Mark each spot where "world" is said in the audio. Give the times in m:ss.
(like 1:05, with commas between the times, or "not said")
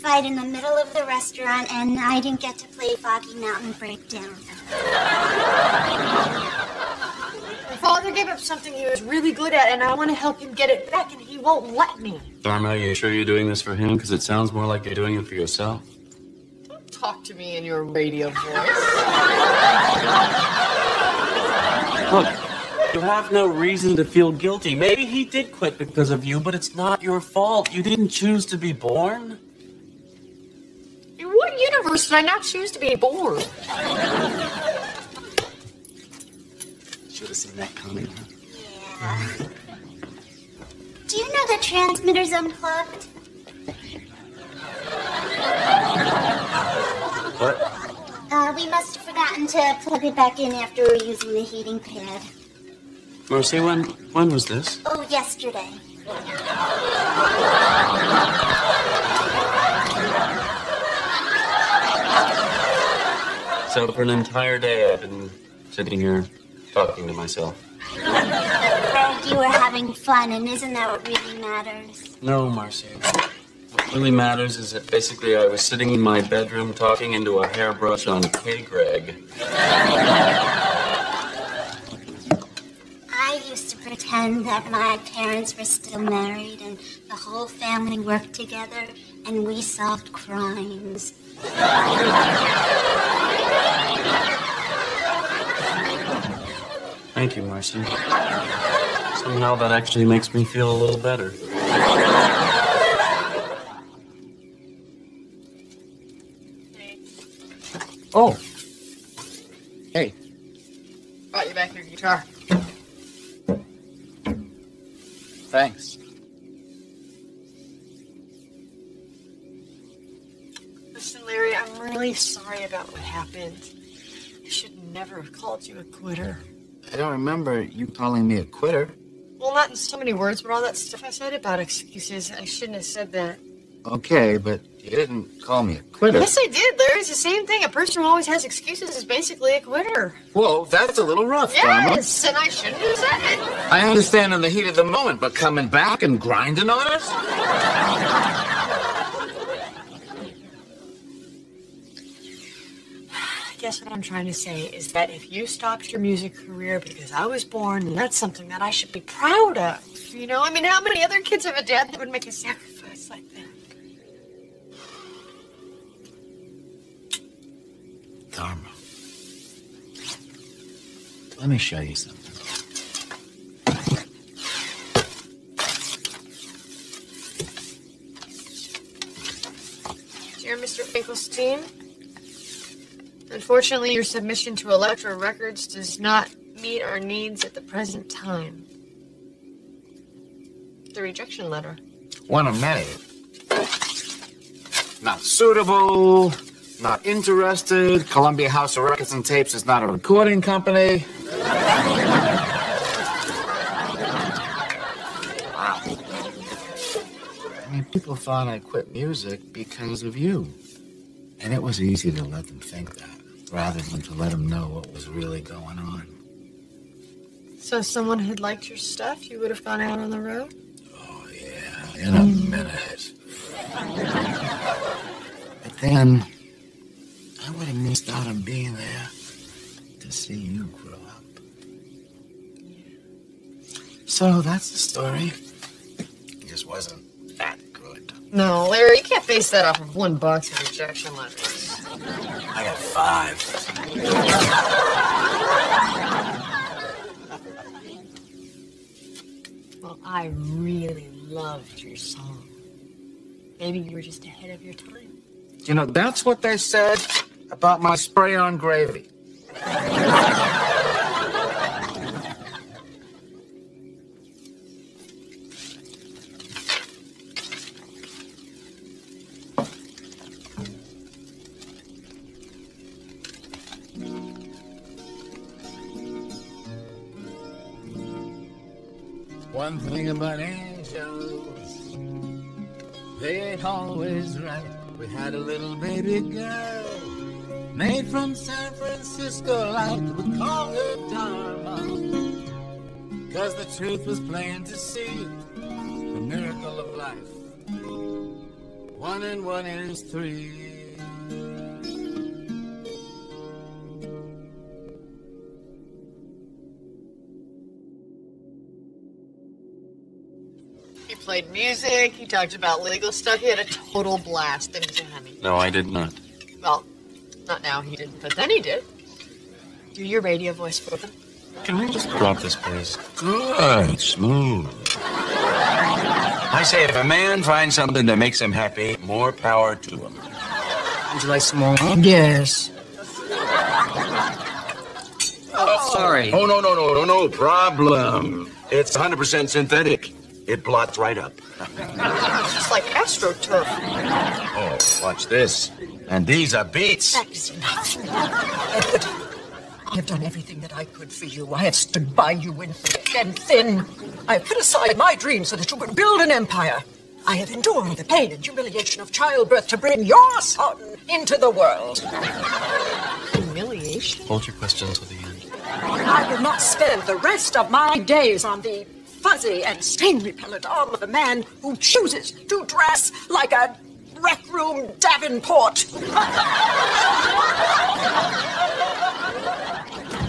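6:01.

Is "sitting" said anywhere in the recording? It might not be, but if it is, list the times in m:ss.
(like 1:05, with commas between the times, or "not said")
1:05, 1:15.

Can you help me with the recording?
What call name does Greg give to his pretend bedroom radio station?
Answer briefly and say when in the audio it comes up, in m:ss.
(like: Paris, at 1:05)
K. Greg, at 1:18.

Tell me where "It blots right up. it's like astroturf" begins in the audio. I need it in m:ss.
5:40.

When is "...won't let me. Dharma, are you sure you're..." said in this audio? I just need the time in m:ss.
0:11.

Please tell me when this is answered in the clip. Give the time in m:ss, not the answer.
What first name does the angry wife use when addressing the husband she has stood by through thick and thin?
5:48.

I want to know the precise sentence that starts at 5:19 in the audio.
Do your radio voice for them.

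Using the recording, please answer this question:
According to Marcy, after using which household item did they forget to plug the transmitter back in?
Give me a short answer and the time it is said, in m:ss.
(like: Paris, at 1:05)
heating pad, at 0:51.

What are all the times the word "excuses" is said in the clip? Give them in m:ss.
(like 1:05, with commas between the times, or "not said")
2:11, 2:18.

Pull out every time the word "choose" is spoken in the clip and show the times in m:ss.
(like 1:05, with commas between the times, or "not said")
0:28, 0:32, 6:11.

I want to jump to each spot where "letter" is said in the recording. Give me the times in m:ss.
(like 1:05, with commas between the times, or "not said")
3:11, 4:01.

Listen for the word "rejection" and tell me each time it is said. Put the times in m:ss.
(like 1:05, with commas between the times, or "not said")
3:11, 4:00.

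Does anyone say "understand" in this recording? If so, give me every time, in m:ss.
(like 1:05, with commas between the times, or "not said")
2:23.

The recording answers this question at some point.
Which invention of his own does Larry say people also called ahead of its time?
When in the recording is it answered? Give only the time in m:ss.
4:17.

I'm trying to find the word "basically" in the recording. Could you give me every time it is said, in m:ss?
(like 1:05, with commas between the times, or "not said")
1:14, 2:19.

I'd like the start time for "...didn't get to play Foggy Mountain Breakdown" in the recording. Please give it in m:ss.
0:02.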